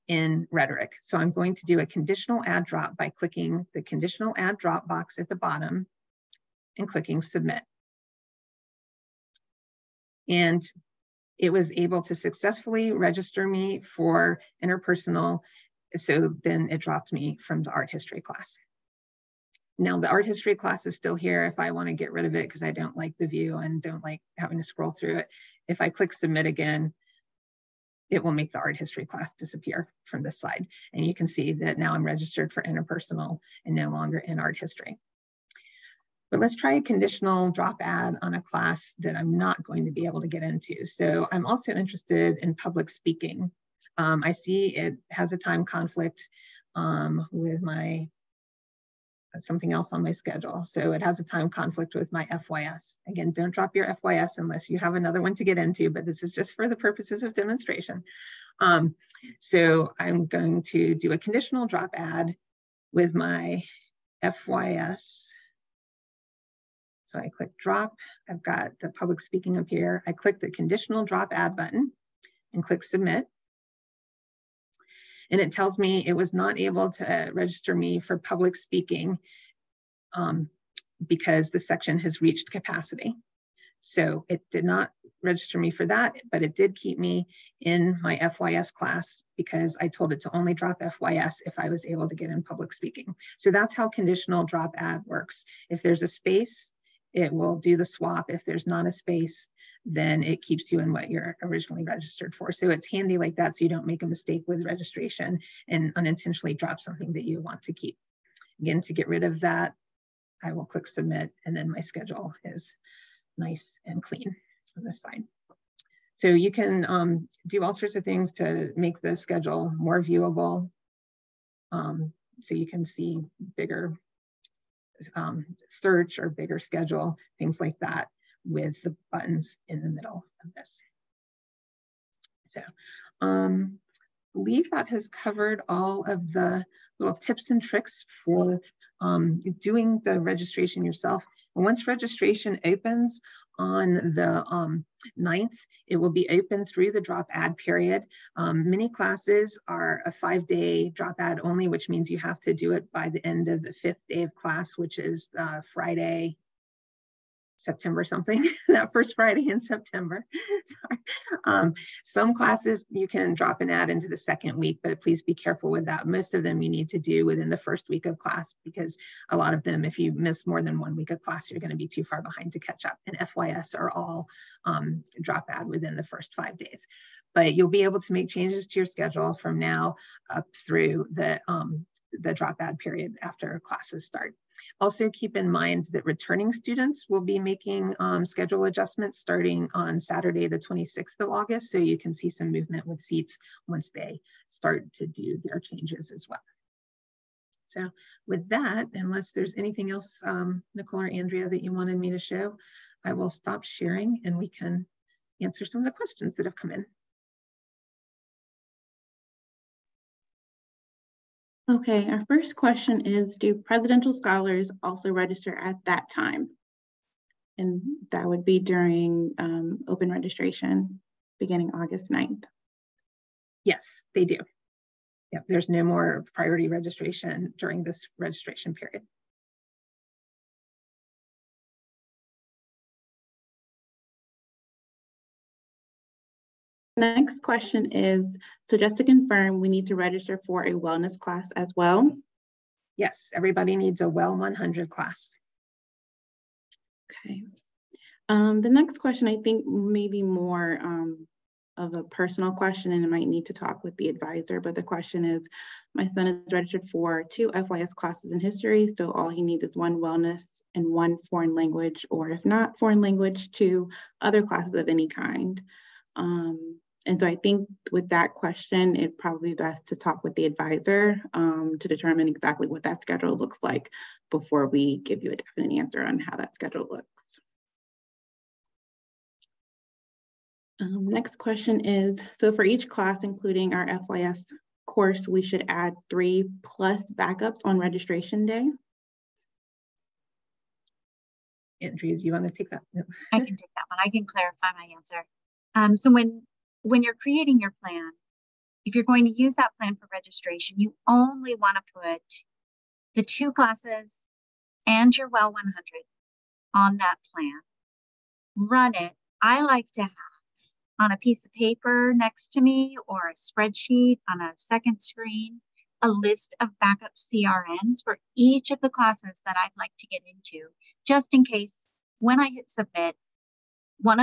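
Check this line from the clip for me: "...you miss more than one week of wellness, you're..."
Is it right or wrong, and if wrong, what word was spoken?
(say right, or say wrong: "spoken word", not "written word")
wrong: "class", not "wellness".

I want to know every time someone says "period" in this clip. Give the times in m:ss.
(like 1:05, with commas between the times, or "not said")
2:27, 3:02, 3:48.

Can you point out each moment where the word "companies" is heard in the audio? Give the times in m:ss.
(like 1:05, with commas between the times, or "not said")
not said.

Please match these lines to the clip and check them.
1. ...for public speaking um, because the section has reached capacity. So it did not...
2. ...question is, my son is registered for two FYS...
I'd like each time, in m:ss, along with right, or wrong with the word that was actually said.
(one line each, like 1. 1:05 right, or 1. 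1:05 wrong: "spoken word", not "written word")
1. 1:18 right
2. 4:14 right.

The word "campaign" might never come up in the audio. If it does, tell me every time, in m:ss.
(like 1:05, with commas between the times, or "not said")
not said.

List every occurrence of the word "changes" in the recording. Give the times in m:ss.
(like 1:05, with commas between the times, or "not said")
2:58, 3:15.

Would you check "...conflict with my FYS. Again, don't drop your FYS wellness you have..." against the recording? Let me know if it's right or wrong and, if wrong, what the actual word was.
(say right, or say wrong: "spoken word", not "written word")
wrong: "unless", not "wellness".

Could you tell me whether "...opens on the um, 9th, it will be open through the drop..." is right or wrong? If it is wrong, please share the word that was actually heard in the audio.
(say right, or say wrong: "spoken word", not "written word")
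right.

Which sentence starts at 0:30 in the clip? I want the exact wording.
And you can see that now I'm registered for interpersonal and no longer in art history.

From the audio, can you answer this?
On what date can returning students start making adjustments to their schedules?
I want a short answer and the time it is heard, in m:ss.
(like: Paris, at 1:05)
August 26, at 3:10.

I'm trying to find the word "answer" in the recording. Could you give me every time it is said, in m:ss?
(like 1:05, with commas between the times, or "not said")
3:25, 4:35, 4:54.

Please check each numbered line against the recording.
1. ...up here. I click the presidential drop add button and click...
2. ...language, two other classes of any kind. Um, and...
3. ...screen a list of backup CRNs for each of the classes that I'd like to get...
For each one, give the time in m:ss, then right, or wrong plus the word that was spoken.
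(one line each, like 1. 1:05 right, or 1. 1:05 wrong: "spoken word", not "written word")
1. 1:09 wrong: "conditional", not "presidential"
2. 4:23 right
3. 5:15 right.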